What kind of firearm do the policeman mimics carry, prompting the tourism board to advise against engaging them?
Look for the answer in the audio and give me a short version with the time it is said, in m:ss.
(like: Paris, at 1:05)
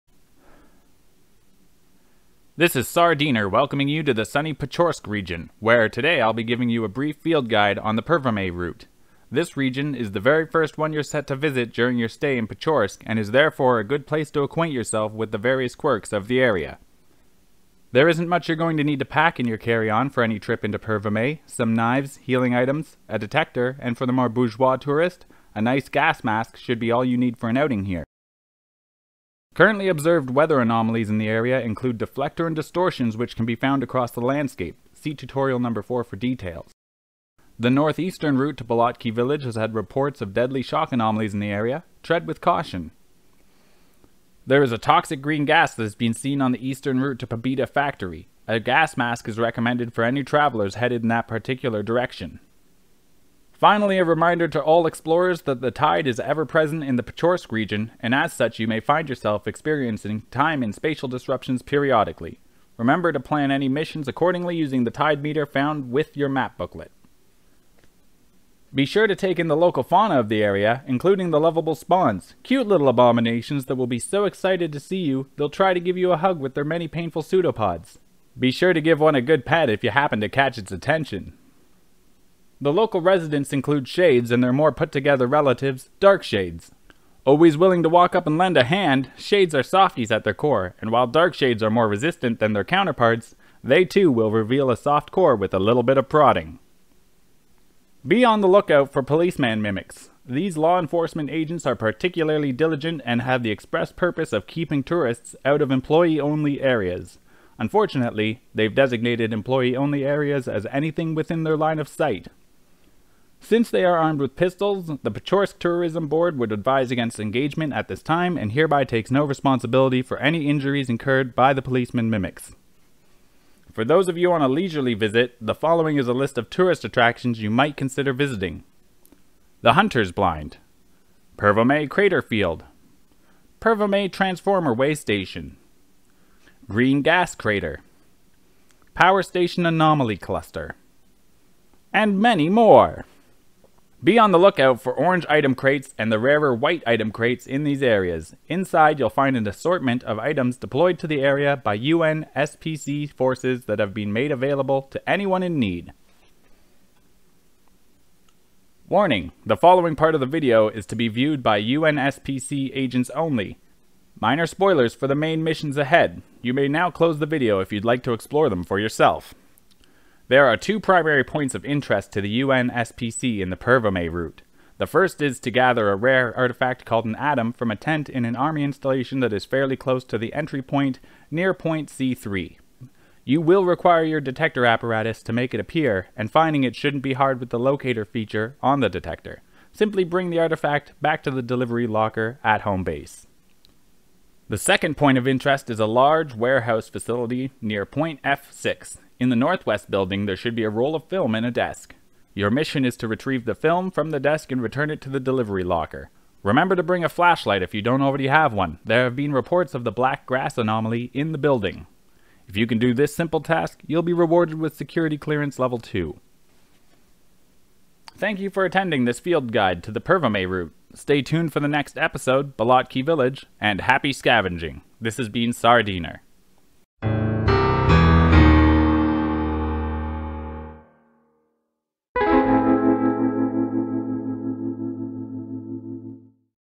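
Pistols, at 1:54.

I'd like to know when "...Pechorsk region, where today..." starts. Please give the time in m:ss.
0:04.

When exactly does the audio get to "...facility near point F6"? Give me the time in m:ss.
3:16.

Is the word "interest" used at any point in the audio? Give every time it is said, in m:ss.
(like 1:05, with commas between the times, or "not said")
2:51, 3:15.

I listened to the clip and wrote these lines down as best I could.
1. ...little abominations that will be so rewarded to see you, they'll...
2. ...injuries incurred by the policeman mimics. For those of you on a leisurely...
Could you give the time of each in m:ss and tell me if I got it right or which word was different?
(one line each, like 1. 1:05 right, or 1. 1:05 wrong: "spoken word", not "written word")
1. 1:12 wrong: "excited", not "rewarded"
2. 2:00 right.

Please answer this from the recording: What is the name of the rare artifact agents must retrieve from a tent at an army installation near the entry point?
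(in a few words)
Atom.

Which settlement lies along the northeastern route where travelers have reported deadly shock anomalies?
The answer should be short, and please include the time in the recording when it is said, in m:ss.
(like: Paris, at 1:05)
Balotki village, at 0:38.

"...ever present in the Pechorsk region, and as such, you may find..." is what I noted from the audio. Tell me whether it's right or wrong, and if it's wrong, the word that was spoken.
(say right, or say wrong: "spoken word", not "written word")
right.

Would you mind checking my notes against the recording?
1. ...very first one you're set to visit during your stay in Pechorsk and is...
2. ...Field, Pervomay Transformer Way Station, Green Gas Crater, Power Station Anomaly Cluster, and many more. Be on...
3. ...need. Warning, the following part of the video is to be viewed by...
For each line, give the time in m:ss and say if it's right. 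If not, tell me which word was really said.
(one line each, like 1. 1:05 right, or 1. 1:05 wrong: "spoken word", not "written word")
1. 0:10 right
2. 2:12 right
3. 2:35 right.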